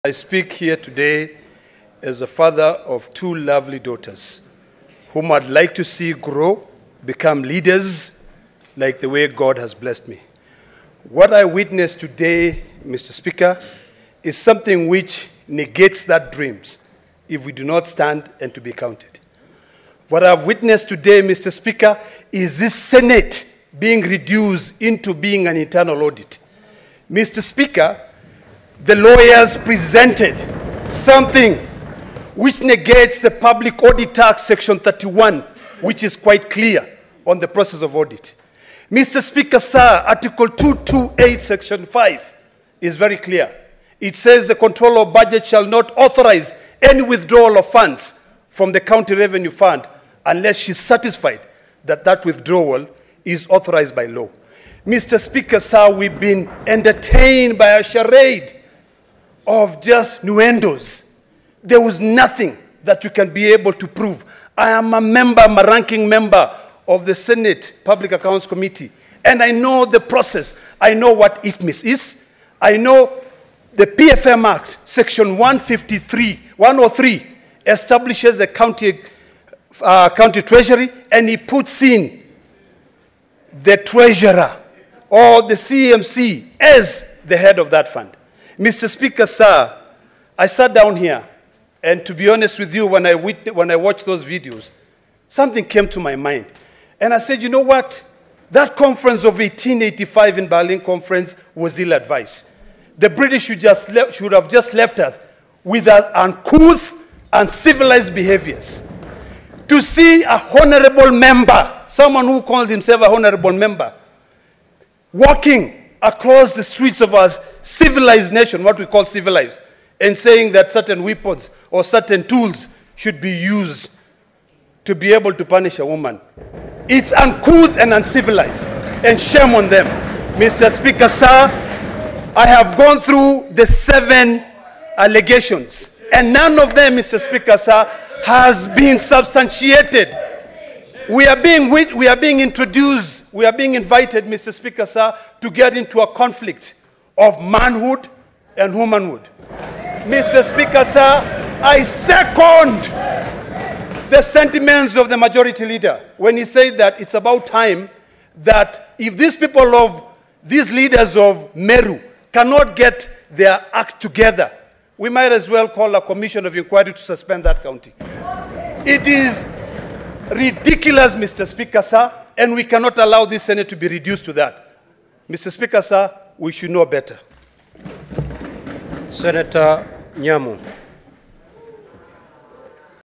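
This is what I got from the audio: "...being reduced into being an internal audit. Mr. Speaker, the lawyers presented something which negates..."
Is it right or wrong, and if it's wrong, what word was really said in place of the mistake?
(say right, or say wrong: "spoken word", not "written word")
right.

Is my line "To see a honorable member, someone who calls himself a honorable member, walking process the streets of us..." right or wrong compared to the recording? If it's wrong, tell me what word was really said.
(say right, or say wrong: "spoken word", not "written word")
wrong: "across", not "process".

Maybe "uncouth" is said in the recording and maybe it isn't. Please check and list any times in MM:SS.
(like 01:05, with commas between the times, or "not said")
01:46, 02:07.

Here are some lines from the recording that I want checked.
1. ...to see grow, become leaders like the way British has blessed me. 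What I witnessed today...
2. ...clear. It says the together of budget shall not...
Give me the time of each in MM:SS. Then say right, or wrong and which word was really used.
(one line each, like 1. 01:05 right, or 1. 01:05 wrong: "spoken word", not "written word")
1. 00:05 wrong: "God", not "British"
2. 00:43 wrong: "controller", not "together".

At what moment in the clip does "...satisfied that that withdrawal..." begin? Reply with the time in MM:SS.
00:50.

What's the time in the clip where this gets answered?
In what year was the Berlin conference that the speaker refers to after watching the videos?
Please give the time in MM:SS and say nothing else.
01:39.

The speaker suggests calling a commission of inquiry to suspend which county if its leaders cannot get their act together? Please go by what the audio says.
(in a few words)
Meru.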